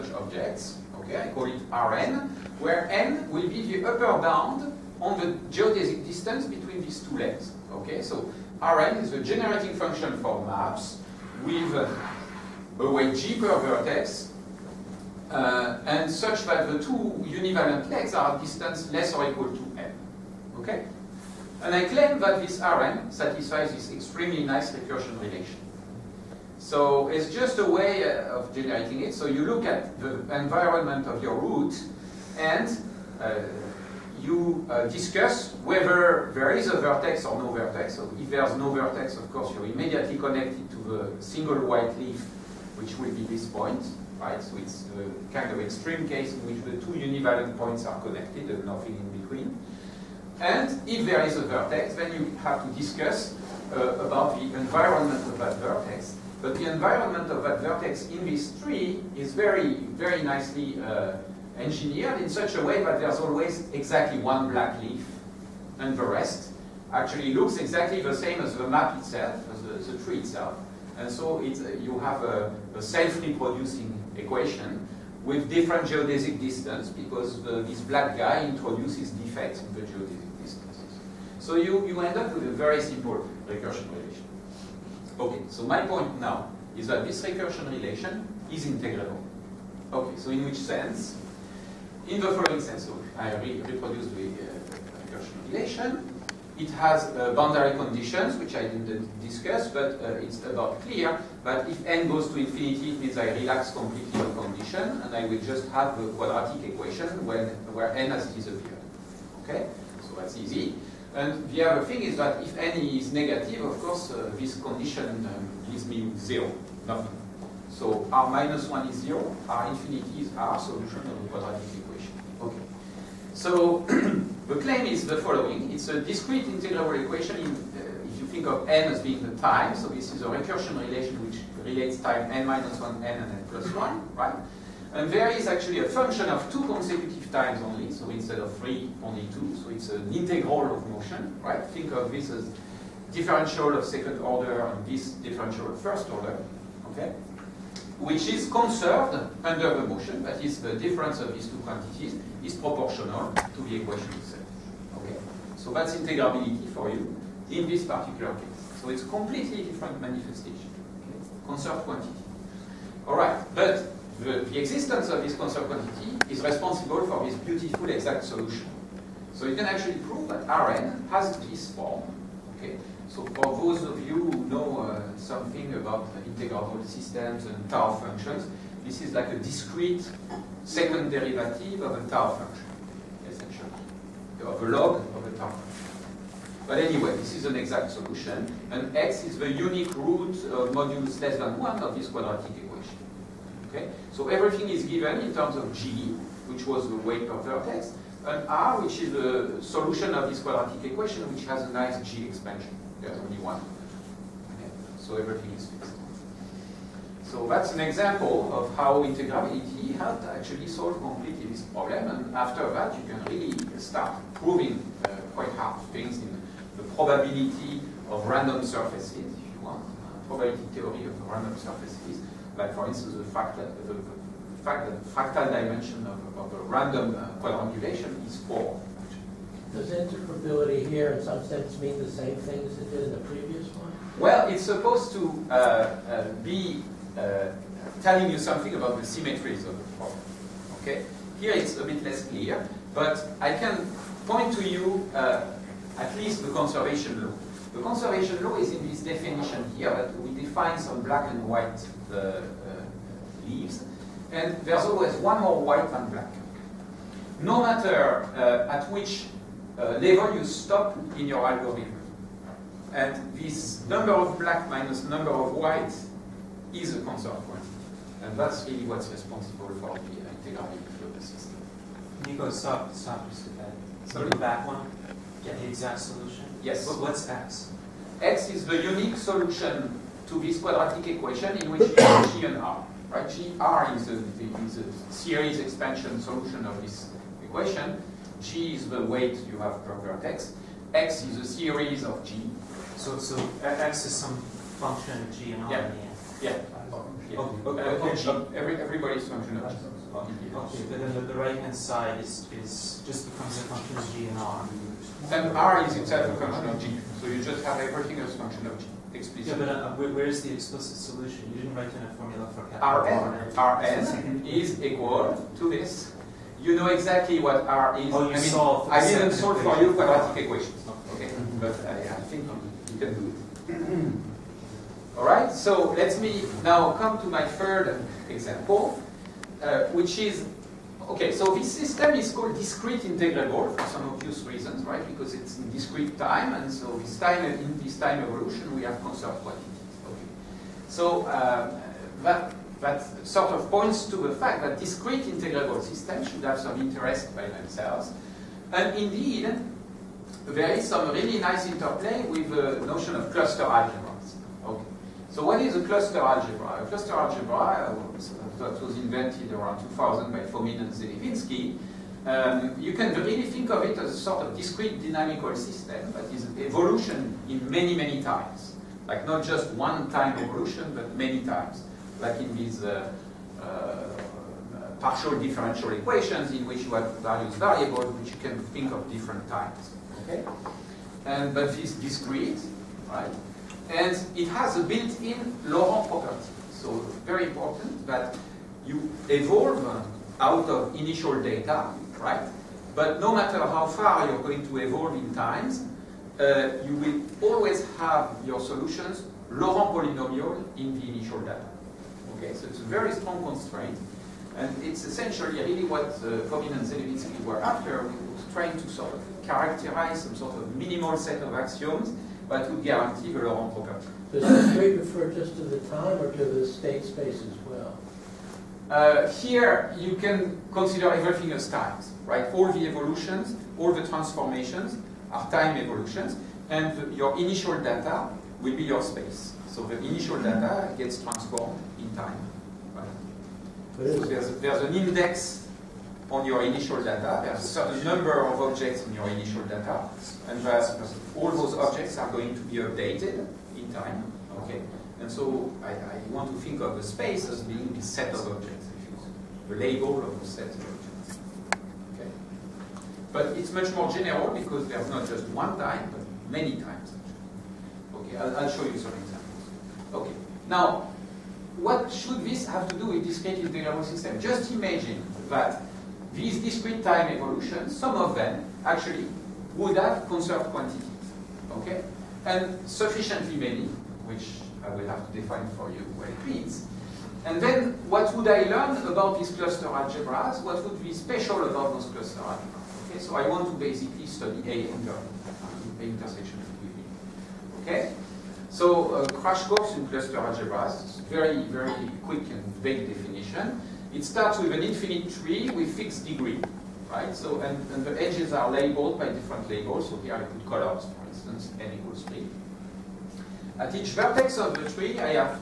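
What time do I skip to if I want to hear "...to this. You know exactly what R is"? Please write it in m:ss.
5:15.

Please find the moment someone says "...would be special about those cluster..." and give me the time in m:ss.
8:00.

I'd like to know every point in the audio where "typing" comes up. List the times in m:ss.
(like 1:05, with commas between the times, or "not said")
not said.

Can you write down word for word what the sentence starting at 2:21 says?
Think of this as differential of second order and this differential of first order, okay?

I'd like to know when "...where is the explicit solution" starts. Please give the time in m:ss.
5:10.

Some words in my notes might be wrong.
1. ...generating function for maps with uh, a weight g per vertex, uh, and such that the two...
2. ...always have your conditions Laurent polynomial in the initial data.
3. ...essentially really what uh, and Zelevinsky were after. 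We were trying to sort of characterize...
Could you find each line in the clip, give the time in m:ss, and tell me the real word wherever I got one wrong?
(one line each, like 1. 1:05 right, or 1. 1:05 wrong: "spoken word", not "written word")
1. 0:09 right
2. 6:37 wrong: "solutions", not "conditions"
3. 6:45 right.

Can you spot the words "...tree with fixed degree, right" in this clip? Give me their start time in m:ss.
8:15.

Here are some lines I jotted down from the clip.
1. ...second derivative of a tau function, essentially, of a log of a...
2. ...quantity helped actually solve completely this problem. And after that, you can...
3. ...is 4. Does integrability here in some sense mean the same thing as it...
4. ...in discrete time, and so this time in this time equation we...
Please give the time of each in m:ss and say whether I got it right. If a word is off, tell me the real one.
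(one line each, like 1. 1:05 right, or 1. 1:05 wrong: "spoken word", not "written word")
1. 3:00 right
2. 3:29 wrong: "integrability", not "quantity"
3. 3:48 right
4. 5:35 wrong: "evolution", not "equation".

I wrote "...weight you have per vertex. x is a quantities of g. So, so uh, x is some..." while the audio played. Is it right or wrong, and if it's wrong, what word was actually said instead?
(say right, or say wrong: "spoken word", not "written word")
wrong: "series", not "quantities".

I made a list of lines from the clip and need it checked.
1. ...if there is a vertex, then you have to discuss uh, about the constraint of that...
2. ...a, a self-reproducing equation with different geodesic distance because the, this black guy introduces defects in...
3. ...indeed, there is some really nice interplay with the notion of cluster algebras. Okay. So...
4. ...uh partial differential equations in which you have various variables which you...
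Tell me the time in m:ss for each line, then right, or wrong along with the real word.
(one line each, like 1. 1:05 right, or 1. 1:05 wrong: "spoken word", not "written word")
1. 0:50 wrong: "environment", not "constraint"
2. 1:12 right
3. 5:48 right
4. 6:13 right.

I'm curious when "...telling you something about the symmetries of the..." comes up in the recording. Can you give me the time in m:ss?
3:58.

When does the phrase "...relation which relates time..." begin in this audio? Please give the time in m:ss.
2:10.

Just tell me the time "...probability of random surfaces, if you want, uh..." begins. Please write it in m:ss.
3:36.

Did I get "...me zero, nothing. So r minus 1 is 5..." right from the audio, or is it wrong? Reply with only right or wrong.
wrong.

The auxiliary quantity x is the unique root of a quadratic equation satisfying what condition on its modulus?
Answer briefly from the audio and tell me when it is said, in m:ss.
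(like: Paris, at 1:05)
less than 1, at 3:10.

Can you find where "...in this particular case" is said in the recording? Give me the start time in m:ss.
2:37.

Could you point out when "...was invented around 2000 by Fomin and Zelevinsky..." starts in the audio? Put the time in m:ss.
5:58.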